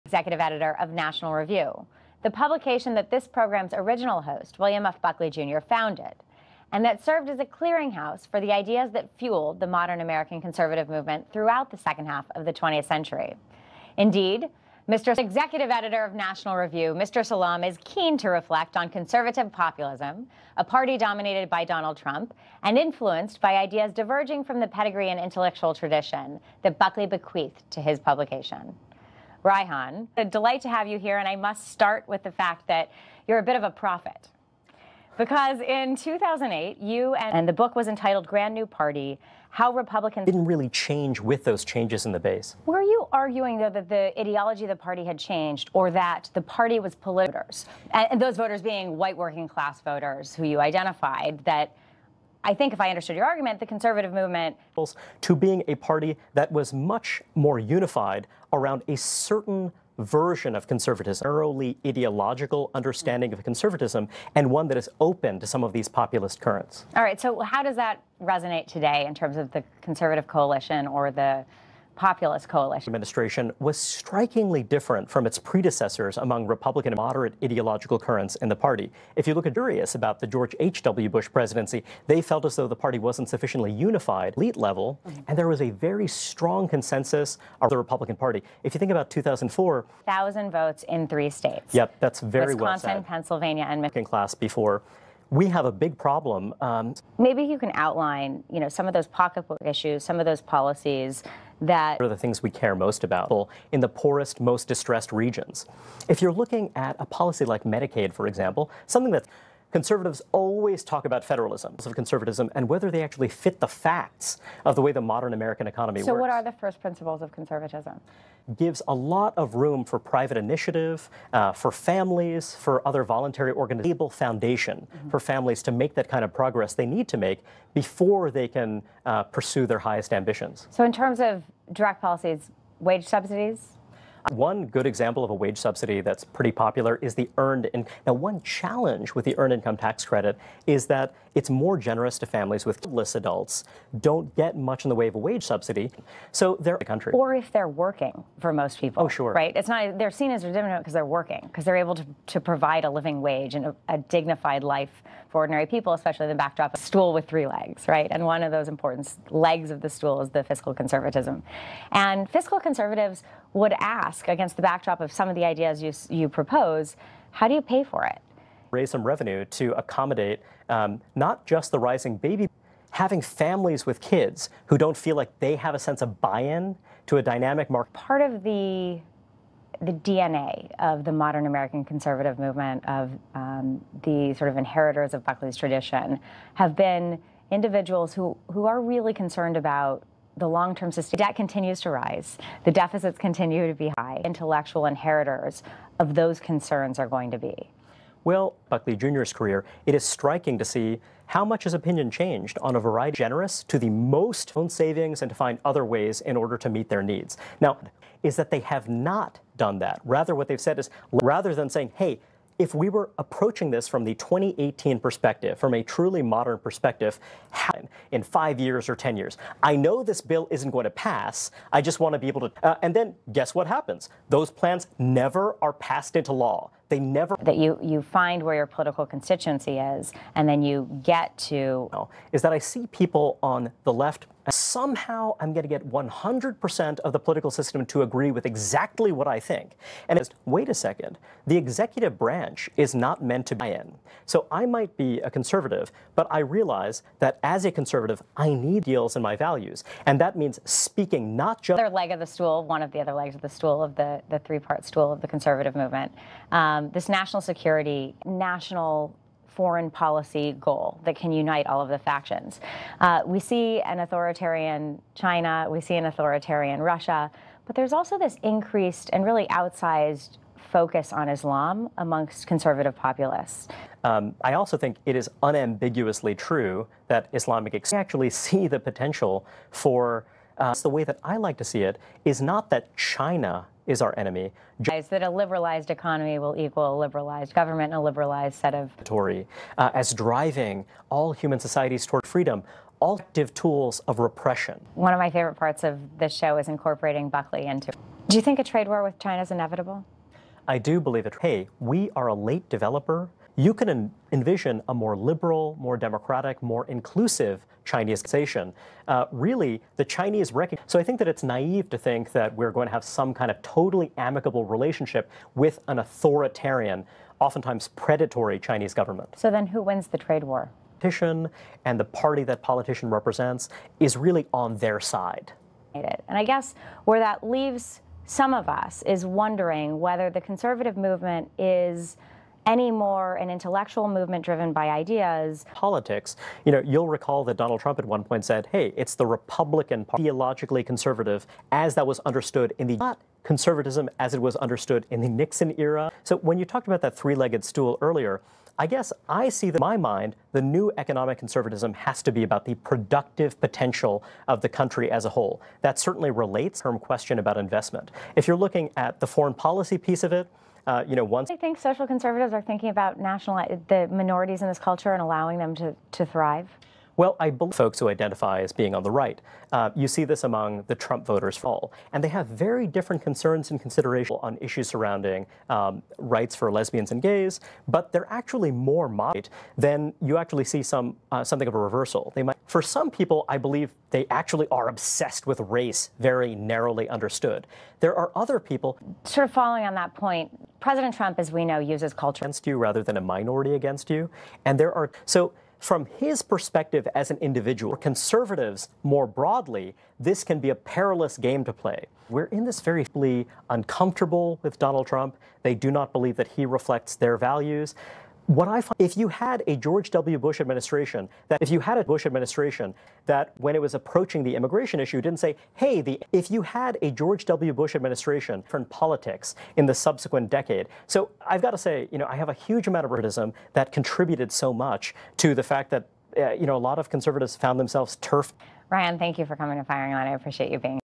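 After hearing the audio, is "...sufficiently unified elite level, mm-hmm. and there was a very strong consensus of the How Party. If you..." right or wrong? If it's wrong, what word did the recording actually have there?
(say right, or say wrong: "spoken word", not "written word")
wrong: "Republican", not "How".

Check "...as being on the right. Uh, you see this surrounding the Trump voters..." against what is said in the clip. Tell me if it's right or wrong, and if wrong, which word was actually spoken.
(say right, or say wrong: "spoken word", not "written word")
wrong: "among", not "surrounding".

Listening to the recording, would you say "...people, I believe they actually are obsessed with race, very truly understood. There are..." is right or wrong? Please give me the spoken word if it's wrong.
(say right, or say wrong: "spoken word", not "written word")
wrong: "narrowly", not "truly".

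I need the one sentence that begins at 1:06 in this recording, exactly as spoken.
All right, so how does that resonate today in terms of the conservative coalition or the populist coalition.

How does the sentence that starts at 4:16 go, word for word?
Um, this national security, national foreign policy goal that can unite all of the factions.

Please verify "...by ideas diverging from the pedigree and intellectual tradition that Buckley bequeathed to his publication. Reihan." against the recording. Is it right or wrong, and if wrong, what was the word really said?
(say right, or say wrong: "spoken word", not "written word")
right.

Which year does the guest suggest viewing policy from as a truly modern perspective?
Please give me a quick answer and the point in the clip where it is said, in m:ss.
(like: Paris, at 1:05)
2018, at 3:34.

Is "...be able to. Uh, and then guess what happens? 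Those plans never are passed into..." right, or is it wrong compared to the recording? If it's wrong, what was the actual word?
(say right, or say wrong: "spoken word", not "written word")
right.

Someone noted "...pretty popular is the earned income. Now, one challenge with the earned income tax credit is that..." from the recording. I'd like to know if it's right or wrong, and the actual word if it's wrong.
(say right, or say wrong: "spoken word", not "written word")
right.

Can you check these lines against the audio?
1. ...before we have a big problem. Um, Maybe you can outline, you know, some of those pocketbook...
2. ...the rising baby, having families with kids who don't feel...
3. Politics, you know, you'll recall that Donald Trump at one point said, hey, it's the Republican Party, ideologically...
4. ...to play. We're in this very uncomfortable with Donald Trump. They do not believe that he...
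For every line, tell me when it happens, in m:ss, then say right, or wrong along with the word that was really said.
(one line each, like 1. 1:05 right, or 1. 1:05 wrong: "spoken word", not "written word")
1. 1:34 right
2. 2:51 right
3. 5:35 right
4. 6:41 right.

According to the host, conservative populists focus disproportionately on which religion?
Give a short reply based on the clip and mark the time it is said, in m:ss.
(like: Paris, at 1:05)
Islam, at 4:31.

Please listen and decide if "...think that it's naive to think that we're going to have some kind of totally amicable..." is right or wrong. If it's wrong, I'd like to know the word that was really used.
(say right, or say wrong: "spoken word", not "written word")
right.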